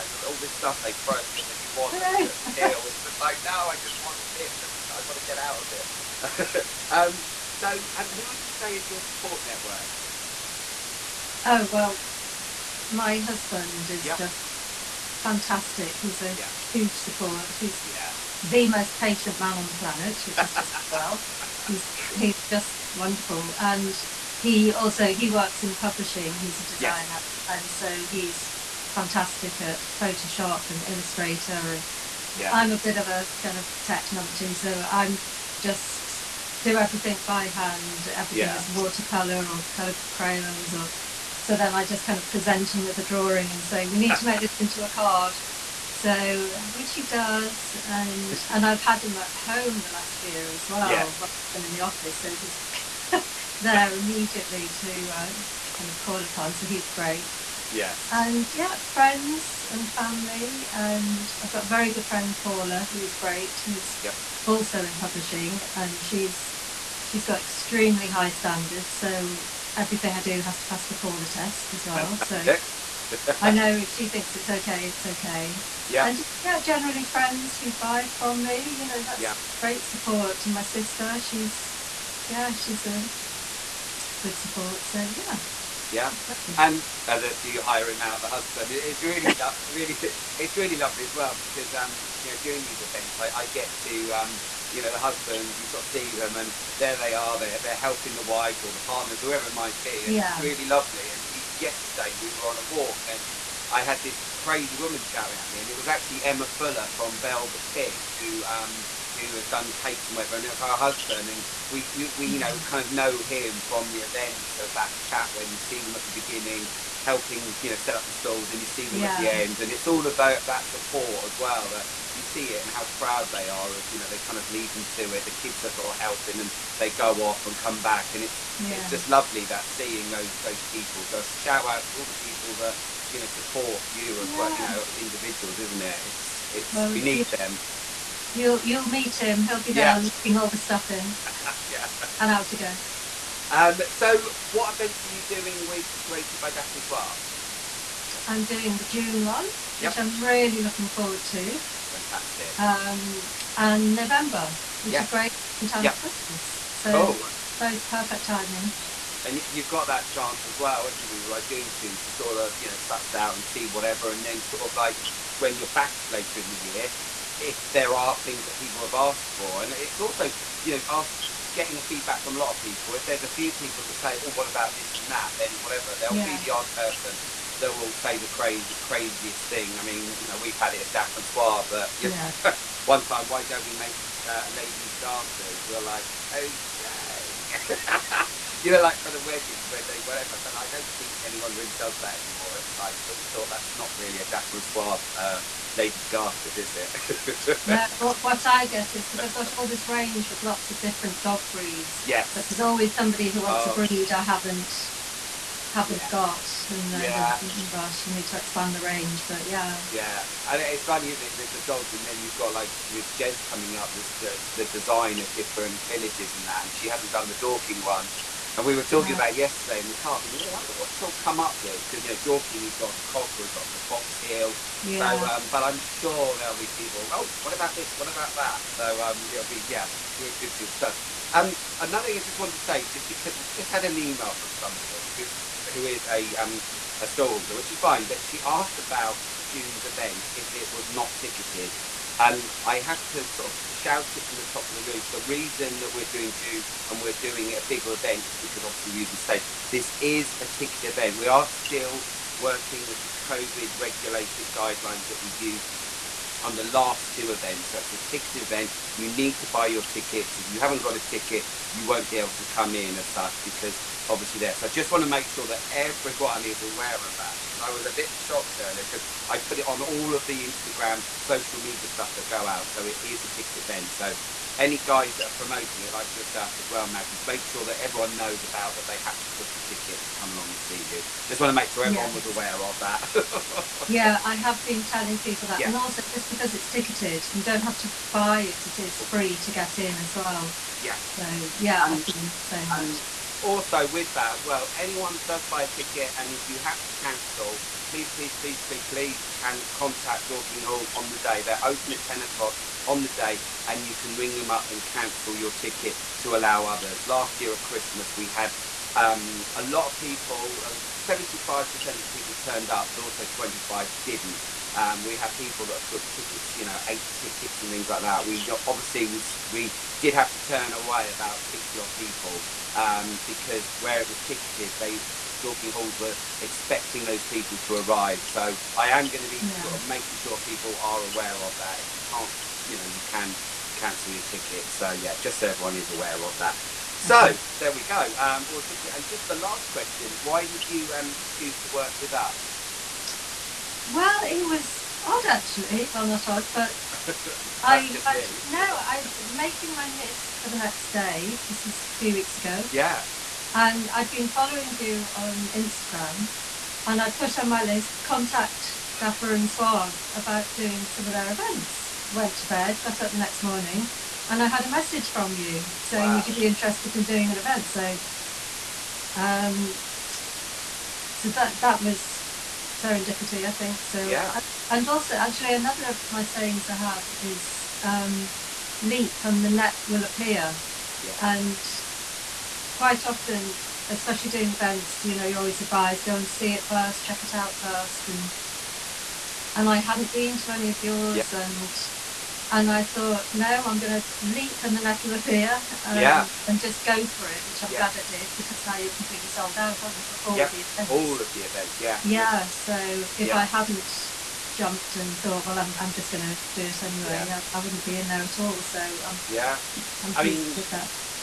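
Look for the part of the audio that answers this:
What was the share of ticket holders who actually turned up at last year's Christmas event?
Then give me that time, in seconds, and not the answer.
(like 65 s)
311 s.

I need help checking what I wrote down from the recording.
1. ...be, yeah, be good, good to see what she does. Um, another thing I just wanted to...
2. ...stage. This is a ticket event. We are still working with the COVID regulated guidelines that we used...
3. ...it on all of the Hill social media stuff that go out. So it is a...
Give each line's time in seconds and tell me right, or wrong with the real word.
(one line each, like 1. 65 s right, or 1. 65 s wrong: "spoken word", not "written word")
1. 229 s right
2. 249 s right
3. 269 s wrong: "Instagram", not "Hill".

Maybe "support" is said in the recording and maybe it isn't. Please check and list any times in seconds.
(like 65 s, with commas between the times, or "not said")
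9 s, 16 s, 79 s, 84 s, 120 s, 133 s.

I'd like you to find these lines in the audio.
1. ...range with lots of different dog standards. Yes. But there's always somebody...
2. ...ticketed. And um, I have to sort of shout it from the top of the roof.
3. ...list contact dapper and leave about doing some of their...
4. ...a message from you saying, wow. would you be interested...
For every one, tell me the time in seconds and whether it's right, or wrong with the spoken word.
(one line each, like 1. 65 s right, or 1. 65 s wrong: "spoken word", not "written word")
1. 199 s wrong: "breeds", not "standards"
2. 241 s right
3. 357 s wrong: "suave", not "leave"
4. 364 s right.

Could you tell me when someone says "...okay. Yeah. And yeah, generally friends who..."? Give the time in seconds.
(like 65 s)
75 s.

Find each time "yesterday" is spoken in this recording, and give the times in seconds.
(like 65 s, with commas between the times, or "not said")
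101 s, 219 s.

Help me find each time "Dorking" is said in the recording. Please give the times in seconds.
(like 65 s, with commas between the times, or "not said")
217 s, 222 s, 300 s, 325 s.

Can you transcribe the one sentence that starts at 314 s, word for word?
Um, we had people that booked tickets, you know, eight tickets and things like that.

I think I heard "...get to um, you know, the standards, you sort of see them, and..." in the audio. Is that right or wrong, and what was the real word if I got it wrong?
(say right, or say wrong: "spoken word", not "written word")
wrong: "husbands", not "standards".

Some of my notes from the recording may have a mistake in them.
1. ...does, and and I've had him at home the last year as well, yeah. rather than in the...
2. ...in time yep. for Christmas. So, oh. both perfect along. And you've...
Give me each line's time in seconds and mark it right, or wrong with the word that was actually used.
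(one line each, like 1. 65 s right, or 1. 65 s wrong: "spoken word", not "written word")
1. 47 s right
2. 155 s wrong: "timing", not "along".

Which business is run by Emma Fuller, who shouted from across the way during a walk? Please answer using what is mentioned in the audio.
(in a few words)
Velvet Fig.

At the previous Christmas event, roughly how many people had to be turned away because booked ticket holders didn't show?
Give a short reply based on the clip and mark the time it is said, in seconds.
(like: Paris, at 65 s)
60, at 321 s.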